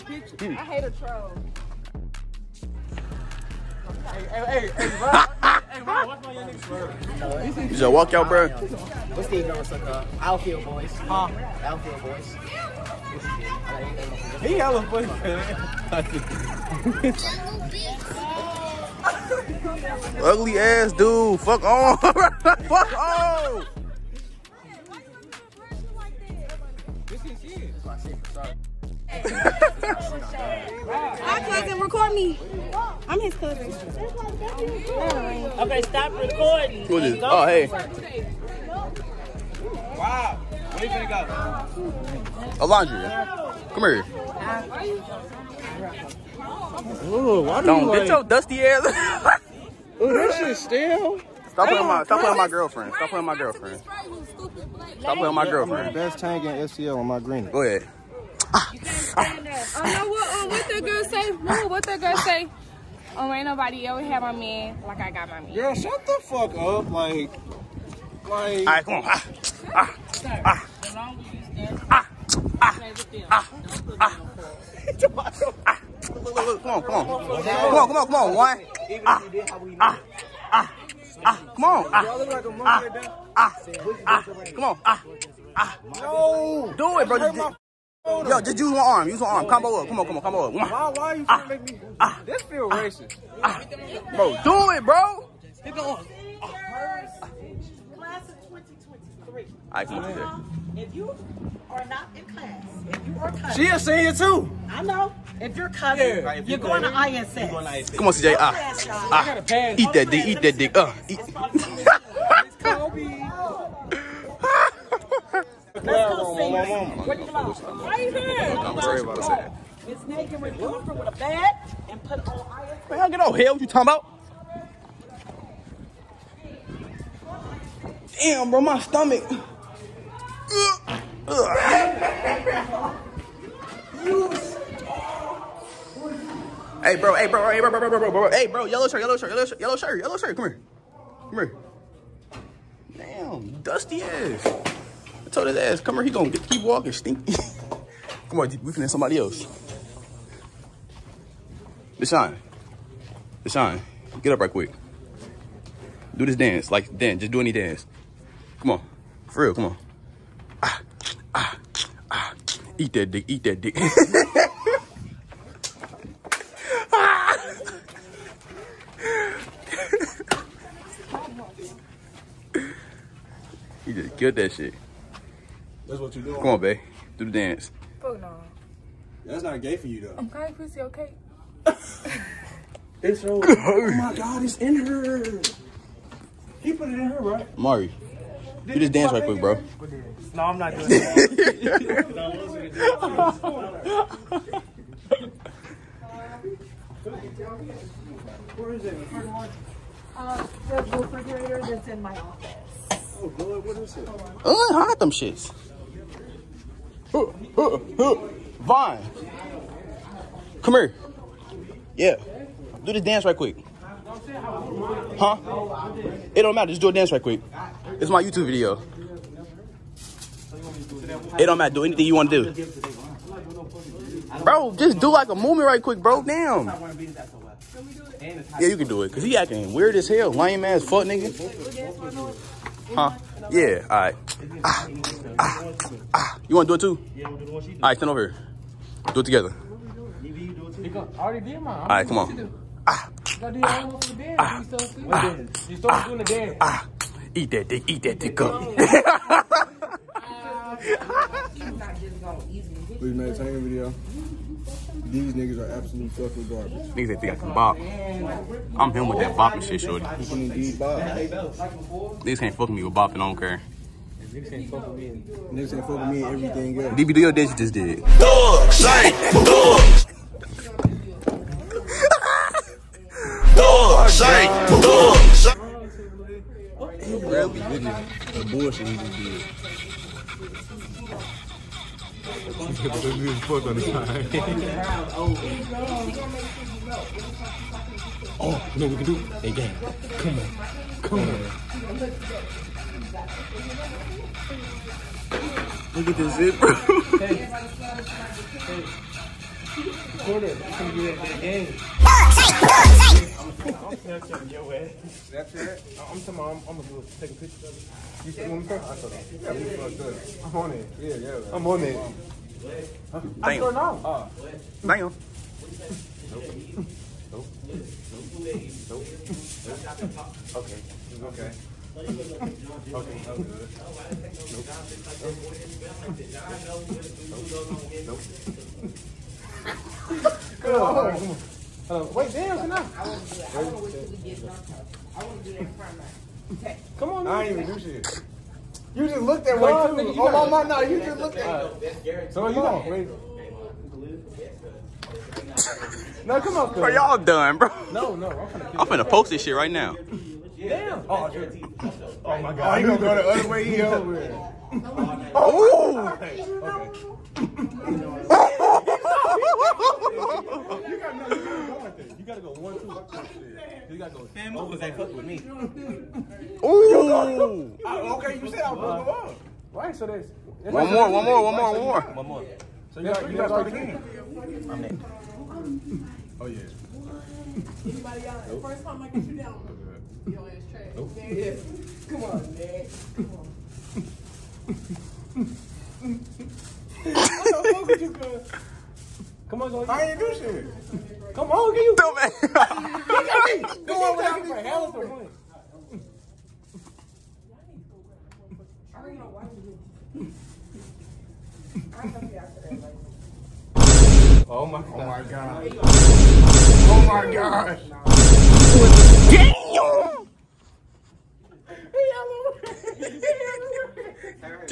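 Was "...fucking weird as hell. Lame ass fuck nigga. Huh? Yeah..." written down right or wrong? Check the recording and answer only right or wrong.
wrong.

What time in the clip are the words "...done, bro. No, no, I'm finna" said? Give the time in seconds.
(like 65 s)
347 s.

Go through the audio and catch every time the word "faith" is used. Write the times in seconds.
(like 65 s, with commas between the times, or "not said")
not said.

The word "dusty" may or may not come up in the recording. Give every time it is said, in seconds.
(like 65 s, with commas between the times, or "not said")
48 s, 143 s.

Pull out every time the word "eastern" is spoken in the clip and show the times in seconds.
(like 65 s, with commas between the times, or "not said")
not said.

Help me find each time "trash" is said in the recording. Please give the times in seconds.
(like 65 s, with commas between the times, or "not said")
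380 s.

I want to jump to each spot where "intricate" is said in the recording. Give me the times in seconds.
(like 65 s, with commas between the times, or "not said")
not said.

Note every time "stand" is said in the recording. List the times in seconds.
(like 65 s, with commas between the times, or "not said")
59 s, 71 s, 237 s.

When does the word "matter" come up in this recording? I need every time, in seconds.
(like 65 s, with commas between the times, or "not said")
216 s, 221 s.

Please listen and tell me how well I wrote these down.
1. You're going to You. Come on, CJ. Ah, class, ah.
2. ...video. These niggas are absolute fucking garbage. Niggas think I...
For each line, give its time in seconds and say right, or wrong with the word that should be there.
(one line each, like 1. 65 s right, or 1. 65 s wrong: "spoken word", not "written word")
1. 107 s wrong: "ISS", not "You"
2. 253 s right.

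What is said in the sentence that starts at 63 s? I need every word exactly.
Oh, ain't nobody ever had my man like I got my man.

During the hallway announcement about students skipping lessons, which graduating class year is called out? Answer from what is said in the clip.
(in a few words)
Class of 2023.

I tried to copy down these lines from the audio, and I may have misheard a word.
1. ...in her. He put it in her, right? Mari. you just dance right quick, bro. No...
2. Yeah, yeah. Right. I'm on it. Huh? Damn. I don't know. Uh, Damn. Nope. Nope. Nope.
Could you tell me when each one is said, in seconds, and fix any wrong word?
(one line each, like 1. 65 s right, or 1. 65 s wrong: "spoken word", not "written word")
1. 184 s right
2. 310 s right.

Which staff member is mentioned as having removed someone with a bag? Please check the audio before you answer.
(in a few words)
Miss Megan.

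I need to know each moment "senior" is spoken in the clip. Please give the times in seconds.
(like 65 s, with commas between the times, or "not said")
103 s.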